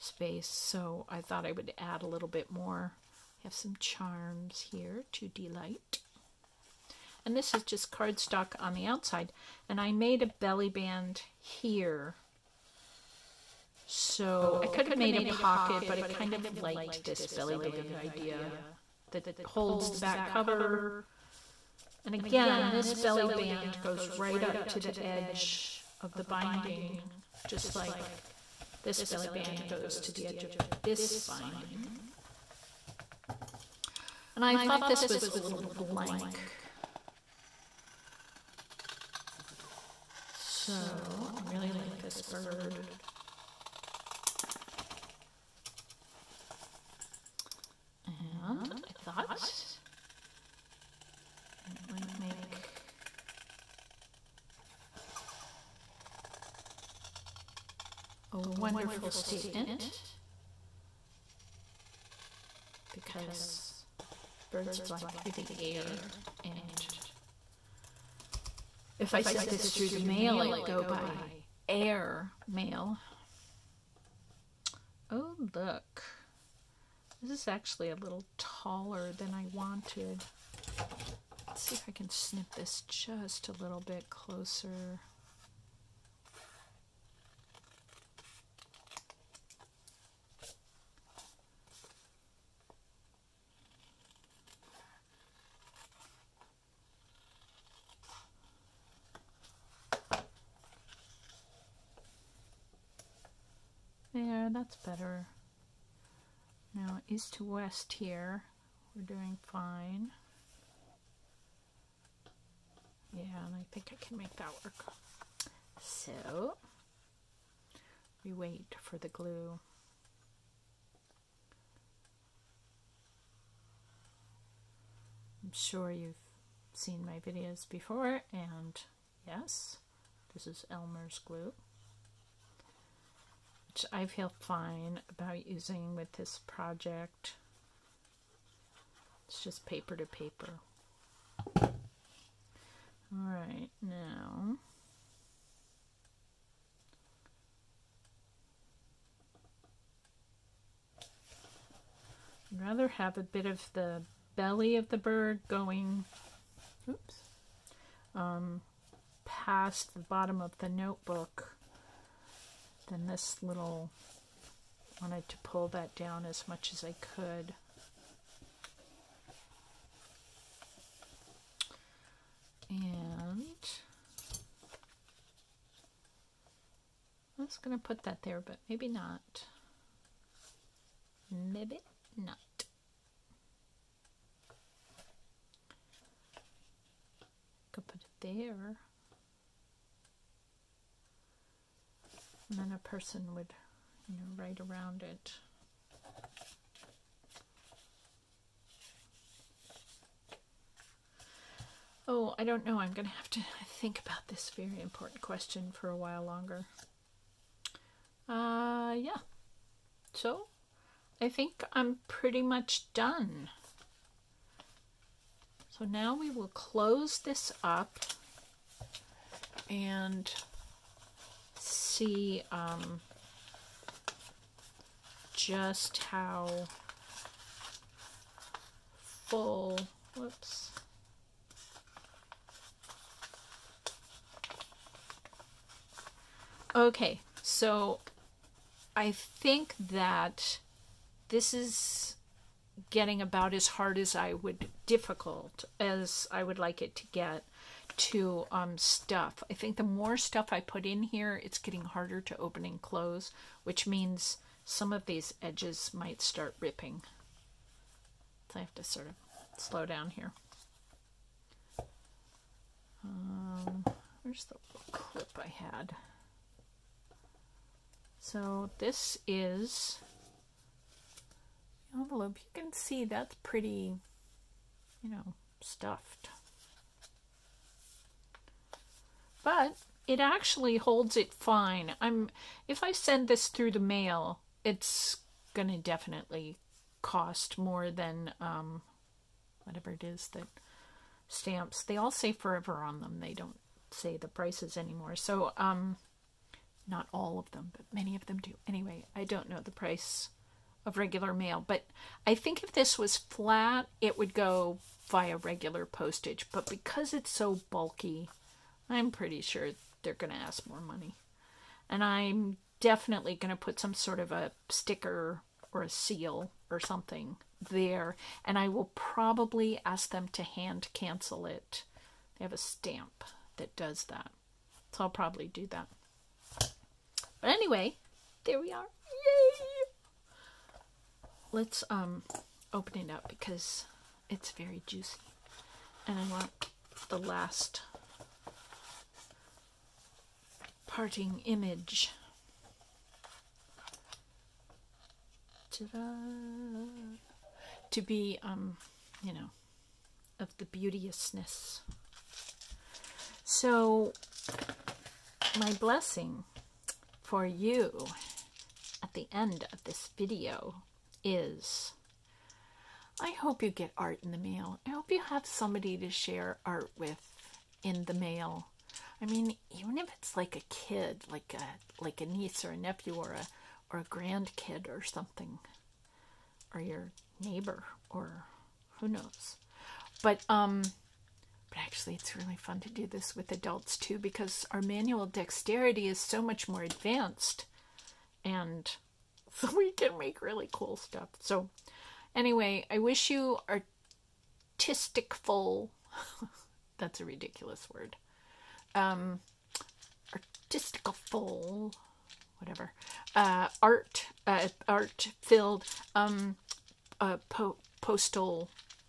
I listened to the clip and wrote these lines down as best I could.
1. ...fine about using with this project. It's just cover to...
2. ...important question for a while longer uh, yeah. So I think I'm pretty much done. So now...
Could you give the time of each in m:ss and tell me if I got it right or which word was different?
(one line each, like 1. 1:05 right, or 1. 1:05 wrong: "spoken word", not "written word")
1. 2:14 wrong: "paper", not "cover"
2. 3:24 right.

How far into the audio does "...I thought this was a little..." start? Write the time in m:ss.
0:34.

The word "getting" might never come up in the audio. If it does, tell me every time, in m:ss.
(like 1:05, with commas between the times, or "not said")
4:02, 4:11.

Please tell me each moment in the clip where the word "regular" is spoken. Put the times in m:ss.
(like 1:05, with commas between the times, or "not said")
5:00, 5:05.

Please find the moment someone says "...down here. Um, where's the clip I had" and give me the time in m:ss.
4:19.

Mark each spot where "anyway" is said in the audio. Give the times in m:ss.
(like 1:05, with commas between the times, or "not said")
4:58, 5:27, 6:32.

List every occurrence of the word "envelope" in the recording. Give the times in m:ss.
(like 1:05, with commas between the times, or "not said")
4:31.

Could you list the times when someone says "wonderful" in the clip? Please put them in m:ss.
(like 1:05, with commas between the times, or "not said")
0:58.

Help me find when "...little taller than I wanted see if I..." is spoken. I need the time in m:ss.
1:17.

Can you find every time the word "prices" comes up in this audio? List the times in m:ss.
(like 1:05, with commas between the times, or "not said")
4:54, 4:59.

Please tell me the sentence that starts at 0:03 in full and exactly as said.
I have some charms here to delight.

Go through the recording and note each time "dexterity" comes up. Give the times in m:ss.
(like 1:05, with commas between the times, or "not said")
6:25.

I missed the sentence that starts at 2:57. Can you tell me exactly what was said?
was going to put that there, but maybe not.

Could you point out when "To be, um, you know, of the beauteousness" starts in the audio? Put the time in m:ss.
5:47.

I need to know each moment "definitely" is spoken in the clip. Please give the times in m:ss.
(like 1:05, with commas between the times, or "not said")
4:45, 5:12.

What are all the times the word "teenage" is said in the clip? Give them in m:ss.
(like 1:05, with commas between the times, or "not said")
not said.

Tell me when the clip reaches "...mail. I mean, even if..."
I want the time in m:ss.
6:08.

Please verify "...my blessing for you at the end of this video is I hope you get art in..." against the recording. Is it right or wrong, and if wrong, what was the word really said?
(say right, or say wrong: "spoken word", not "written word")
right.